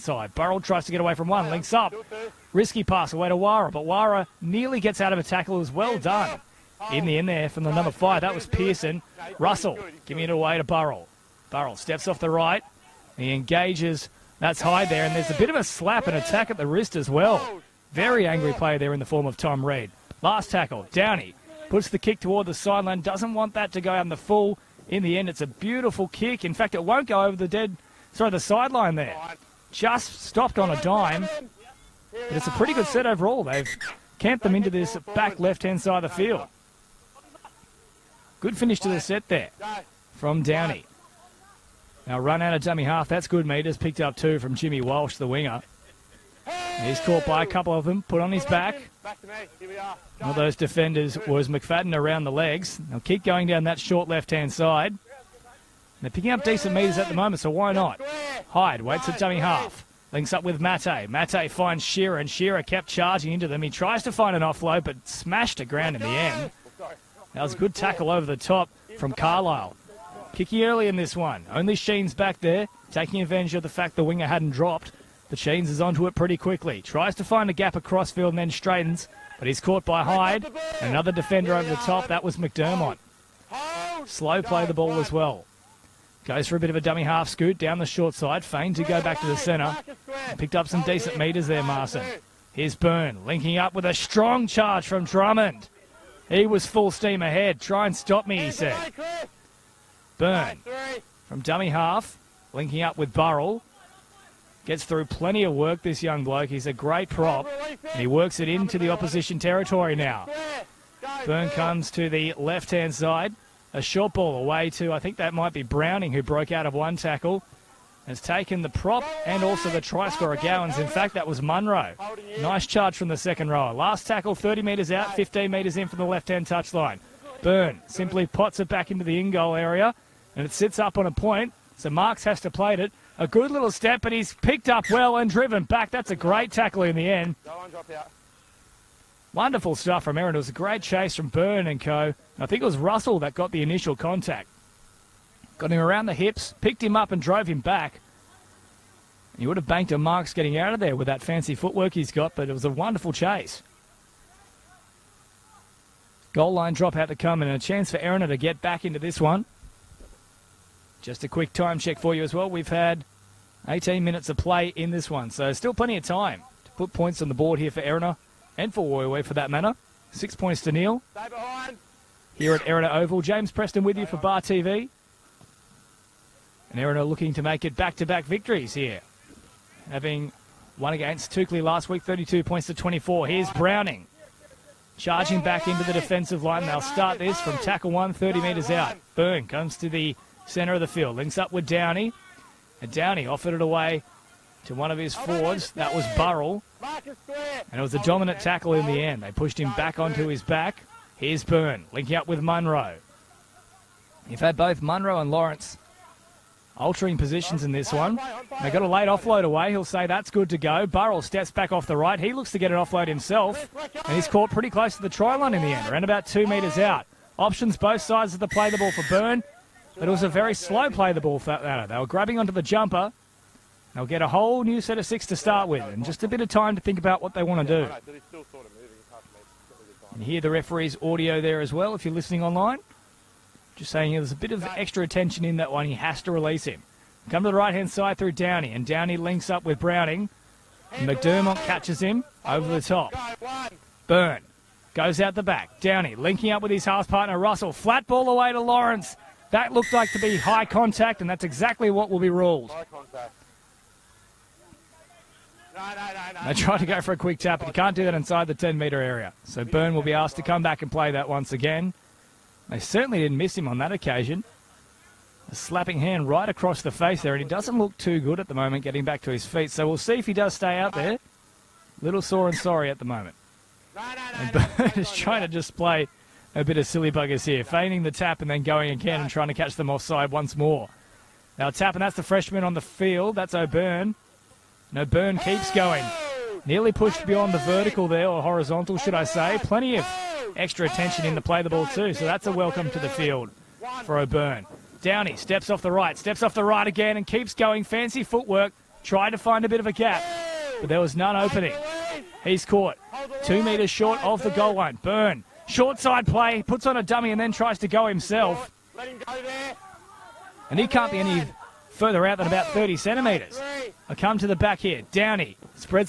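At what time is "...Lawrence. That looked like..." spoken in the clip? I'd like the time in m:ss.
4:08.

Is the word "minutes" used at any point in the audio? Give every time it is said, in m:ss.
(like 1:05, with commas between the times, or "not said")
2:44.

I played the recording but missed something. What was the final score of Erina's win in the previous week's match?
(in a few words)
32 to 24.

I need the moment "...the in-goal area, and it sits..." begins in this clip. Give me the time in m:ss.
2:09.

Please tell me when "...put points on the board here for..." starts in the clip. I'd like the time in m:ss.
2:46.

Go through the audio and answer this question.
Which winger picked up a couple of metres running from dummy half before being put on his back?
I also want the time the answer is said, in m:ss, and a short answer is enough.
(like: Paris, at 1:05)
Jimmy Walsh, at 0:44.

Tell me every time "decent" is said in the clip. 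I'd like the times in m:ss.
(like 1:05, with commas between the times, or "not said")
0:56, 1:30.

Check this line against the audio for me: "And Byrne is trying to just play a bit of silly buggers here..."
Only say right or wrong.
right.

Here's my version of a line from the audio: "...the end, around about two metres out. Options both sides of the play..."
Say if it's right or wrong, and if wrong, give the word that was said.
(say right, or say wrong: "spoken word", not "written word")
right.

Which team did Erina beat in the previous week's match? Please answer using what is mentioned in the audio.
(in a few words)
Toukley.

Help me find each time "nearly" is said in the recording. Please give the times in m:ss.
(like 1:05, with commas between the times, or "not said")
0:04, 4:46.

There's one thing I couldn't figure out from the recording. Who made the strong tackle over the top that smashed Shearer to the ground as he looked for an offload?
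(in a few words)
Carlisle.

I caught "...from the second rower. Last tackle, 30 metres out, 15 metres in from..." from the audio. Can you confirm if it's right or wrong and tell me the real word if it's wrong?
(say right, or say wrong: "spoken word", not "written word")
right.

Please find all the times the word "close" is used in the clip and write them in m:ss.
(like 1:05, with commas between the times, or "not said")
3:34.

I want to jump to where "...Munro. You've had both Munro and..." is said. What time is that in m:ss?
3:22.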